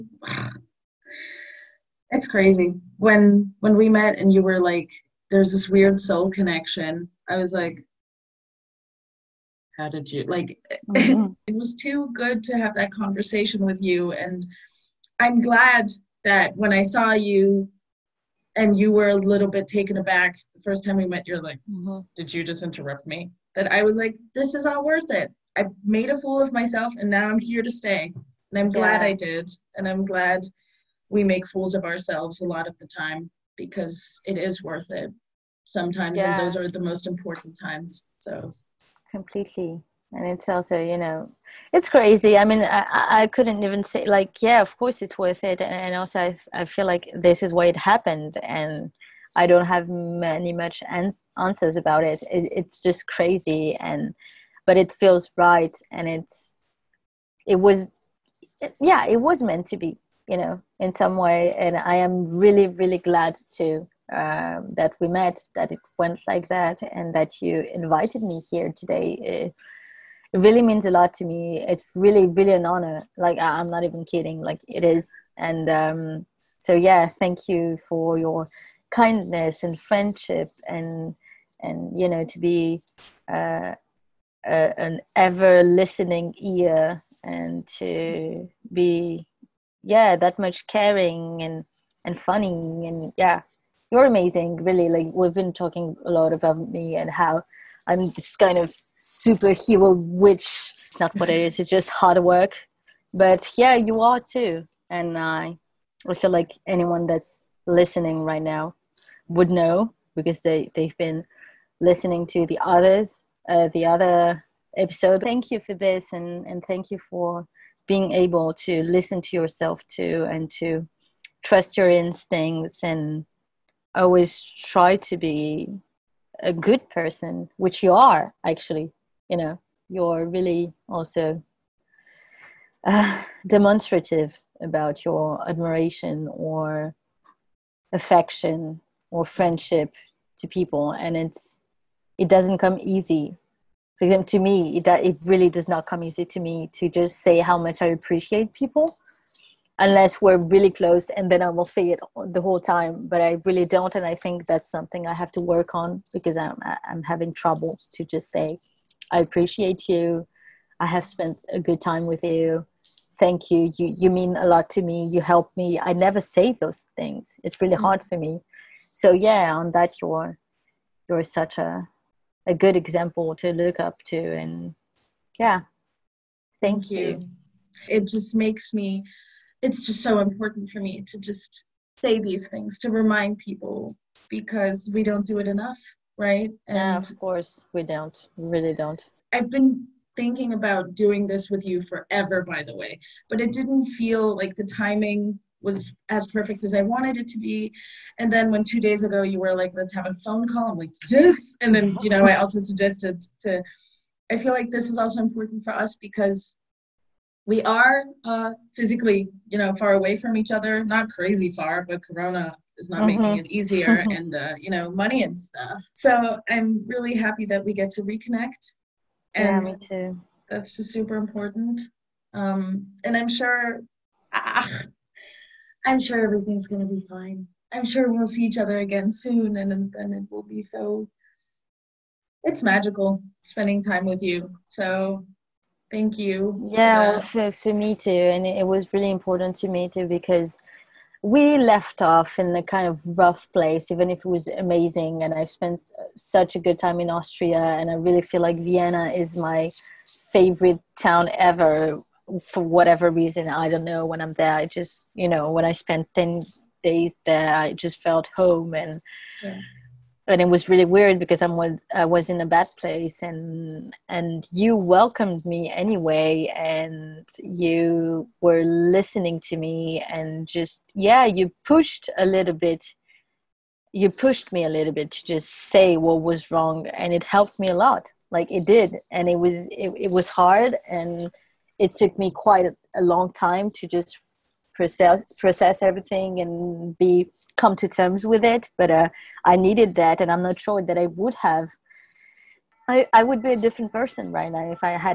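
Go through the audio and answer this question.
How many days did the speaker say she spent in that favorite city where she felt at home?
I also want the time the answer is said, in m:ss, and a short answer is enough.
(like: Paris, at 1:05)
10, at 4:16.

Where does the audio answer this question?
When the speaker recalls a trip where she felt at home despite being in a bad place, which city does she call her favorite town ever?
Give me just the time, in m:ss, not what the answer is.
4:08.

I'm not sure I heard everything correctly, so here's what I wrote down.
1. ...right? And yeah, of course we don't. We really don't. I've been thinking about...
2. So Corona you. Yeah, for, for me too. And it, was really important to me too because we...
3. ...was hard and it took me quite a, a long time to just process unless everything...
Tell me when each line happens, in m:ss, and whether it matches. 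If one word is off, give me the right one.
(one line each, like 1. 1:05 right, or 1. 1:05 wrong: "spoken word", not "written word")
1. 3:06 right
2. 3:54 wrong: "Thank", not "Corona"
3. 4:40 wrong: "process", not "unless".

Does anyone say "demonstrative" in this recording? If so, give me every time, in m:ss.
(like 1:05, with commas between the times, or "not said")
2:13.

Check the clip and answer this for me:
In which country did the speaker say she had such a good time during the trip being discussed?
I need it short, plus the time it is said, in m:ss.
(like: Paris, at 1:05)
Austria, at 4:07.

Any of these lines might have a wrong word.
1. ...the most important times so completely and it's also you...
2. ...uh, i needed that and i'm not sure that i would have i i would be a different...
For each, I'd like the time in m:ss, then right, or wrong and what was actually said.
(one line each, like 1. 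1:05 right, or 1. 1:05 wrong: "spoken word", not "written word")
1. 0:36 right
2. 4:48 right.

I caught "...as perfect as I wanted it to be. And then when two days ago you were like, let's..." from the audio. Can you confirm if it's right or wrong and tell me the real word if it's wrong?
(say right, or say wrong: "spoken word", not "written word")
right.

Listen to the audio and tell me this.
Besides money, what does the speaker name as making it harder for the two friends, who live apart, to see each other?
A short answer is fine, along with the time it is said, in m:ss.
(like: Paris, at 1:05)
Corona, at 3:32.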